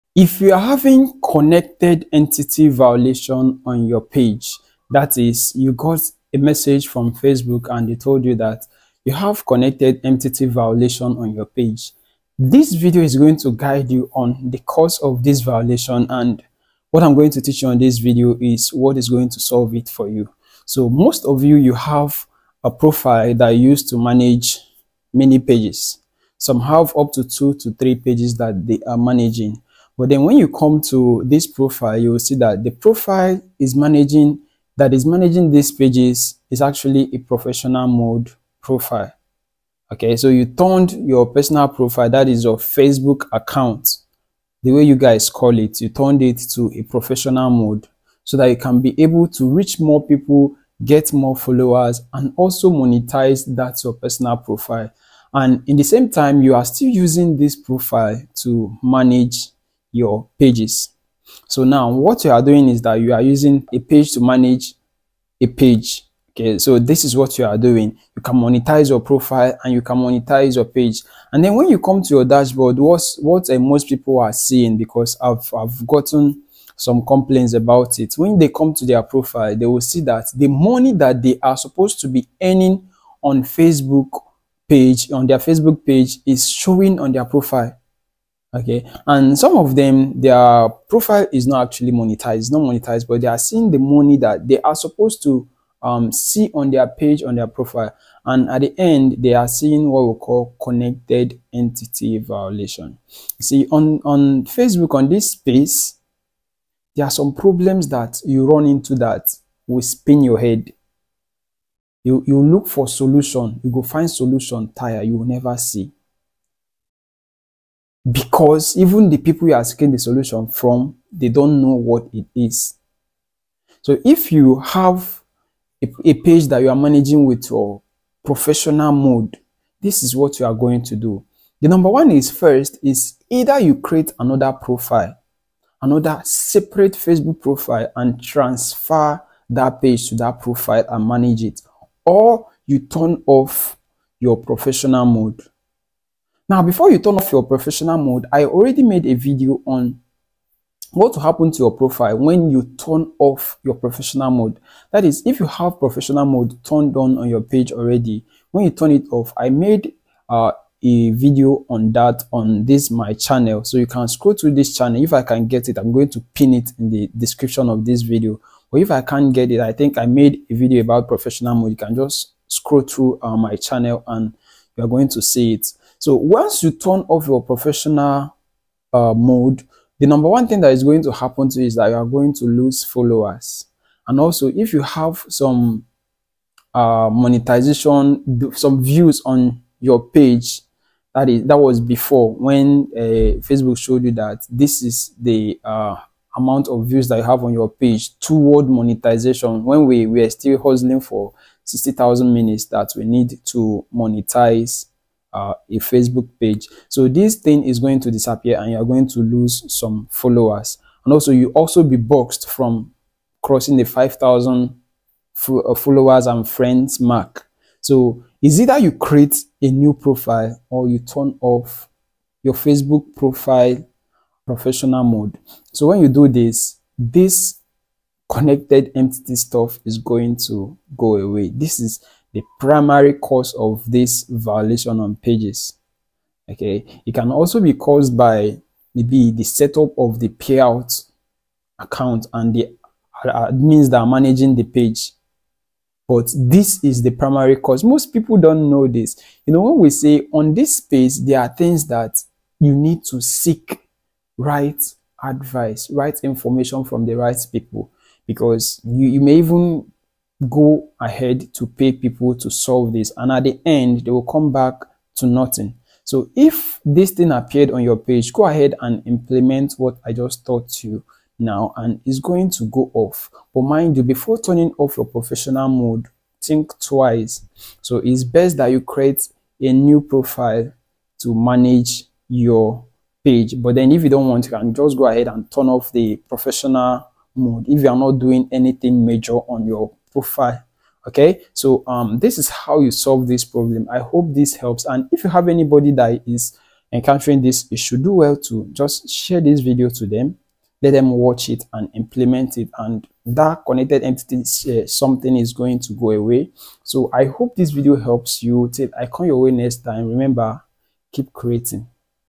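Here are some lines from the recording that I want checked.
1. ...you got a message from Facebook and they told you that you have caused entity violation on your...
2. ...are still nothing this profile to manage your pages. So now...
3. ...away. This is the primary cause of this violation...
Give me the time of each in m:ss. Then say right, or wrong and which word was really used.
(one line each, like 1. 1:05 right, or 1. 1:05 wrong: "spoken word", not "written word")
1. 0:05 wrong: "connected", not "caused"
2. 0:56 wrong: "using", not "nothing"
3. 3:51 right.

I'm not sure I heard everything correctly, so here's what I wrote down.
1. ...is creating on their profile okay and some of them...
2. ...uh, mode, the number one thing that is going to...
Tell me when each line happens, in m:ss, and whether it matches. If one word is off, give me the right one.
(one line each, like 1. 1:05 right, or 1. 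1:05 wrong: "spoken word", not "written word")
1. 1:26 wrong: "showing", not "creating"
2. 2:58 right.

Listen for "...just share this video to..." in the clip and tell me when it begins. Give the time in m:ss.
4:58.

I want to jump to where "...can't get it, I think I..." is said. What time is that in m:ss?
2:49.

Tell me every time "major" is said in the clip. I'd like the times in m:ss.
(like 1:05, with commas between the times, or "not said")
4:49.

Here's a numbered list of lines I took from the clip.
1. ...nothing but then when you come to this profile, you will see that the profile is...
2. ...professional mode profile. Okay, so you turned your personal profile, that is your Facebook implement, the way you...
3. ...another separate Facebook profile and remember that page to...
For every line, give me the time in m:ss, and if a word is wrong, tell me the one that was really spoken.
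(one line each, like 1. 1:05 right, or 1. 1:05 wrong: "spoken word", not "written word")
1. 0:28 wrong: "managing", not "nothing"
2. 0:37 wrong: "account", not "implement"
3. 2:15 wrong: "transfer", not "remember".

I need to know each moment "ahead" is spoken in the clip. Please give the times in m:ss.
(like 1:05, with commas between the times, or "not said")
4:20, 4:28, 4:45.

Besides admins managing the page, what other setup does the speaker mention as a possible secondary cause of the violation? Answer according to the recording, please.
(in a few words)
Payout account.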